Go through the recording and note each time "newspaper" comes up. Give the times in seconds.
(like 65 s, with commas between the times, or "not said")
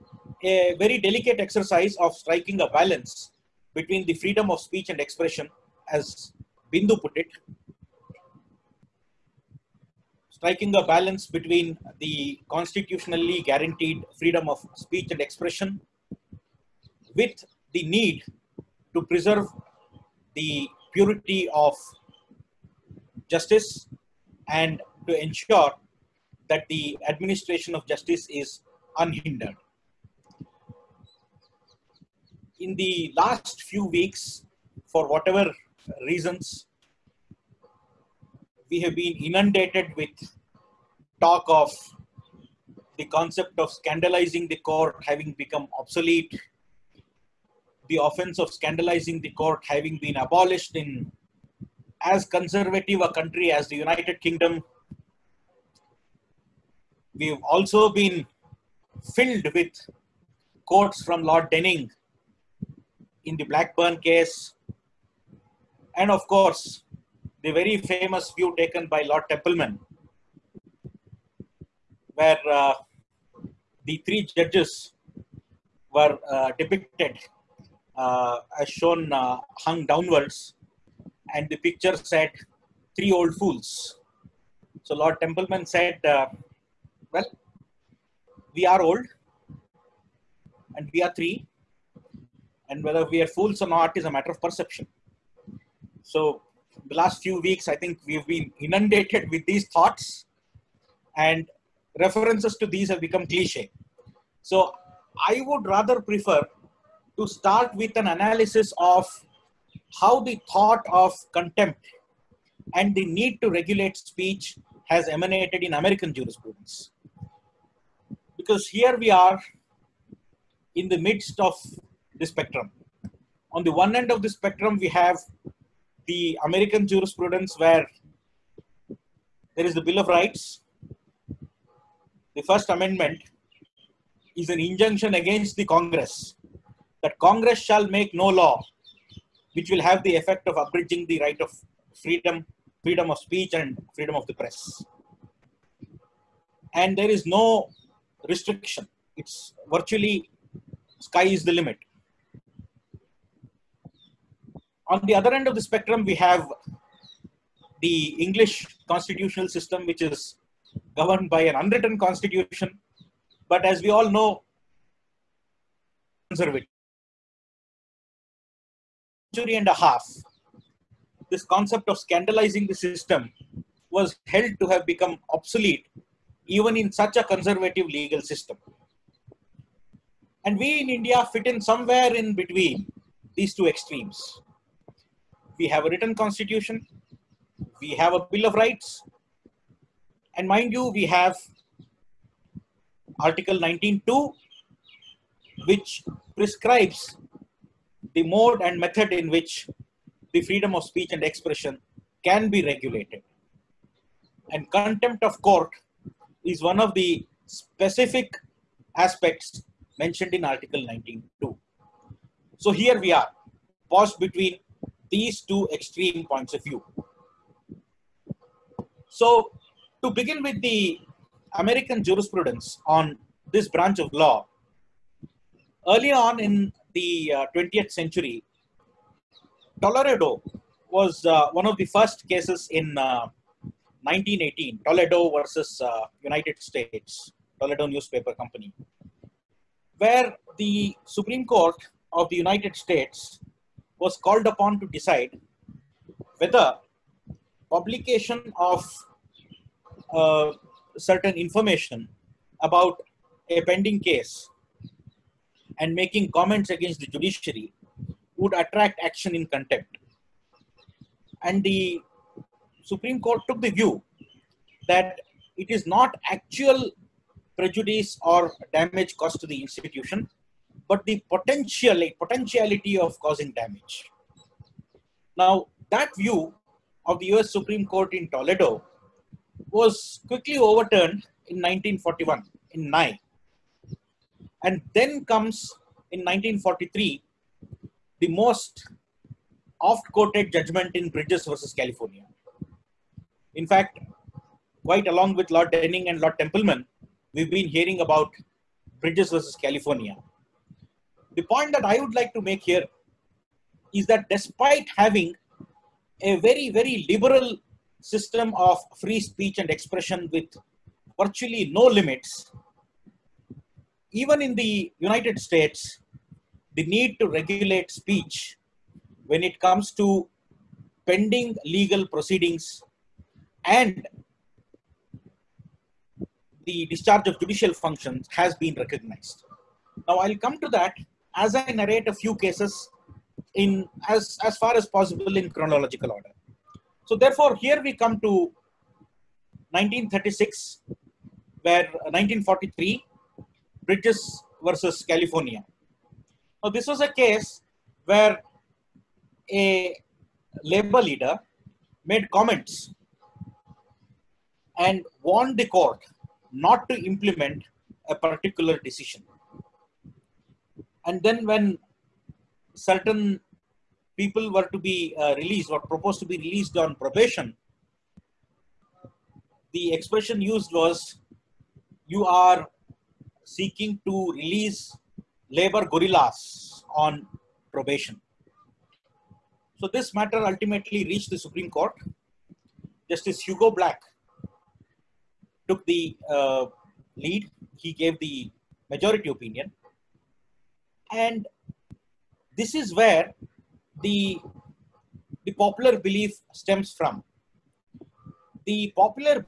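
237 s.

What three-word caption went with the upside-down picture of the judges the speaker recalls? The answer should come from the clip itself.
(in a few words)
Three old fools.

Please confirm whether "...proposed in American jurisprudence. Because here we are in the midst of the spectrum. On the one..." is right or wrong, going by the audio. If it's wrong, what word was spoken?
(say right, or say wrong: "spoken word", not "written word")
wrong: "emanated", not "proposed".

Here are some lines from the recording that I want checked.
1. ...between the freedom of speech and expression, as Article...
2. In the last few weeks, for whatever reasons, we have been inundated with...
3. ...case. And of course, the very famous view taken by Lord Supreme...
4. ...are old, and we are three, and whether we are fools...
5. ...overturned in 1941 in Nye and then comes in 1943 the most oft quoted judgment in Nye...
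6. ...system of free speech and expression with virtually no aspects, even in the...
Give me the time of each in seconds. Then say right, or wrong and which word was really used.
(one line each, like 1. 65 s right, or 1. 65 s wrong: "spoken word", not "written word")
1. 3 s wrong: "Bindu", not "Article"
2. 32 s right
3. 64 s wrong: "Templeman", not "Supreme"
4. 88 s right
5. 280 s wrong: "Bridges", not "Nye"
6. 308 s wrong: "limits", not "aspects".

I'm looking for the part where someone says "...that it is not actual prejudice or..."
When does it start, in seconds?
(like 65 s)
264 s.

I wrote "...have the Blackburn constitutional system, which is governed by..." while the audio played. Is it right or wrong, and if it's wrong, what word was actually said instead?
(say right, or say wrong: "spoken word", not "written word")
wrong: "English", not "Blackburn".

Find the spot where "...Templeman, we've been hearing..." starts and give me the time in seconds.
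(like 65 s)
296 s.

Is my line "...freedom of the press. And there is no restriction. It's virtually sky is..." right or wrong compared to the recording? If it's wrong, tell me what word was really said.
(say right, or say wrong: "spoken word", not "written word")
right.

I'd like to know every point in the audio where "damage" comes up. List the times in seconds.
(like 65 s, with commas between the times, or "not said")
268 s, 273 s.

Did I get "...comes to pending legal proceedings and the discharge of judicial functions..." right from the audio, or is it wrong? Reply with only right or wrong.
right.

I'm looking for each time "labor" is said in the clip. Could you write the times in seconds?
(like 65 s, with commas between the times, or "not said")
350 s, 375 s.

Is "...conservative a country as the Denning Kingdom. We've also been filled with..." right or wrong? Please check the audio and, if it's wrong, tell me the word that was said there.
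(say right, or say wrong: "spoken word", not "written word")
wrong: "United", not "Denning".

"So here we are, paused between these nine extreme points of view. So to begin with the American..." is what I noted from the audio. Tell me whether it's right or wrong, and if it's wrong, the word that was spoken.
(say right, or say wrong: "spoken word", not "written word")
wrong: "two", not "nine".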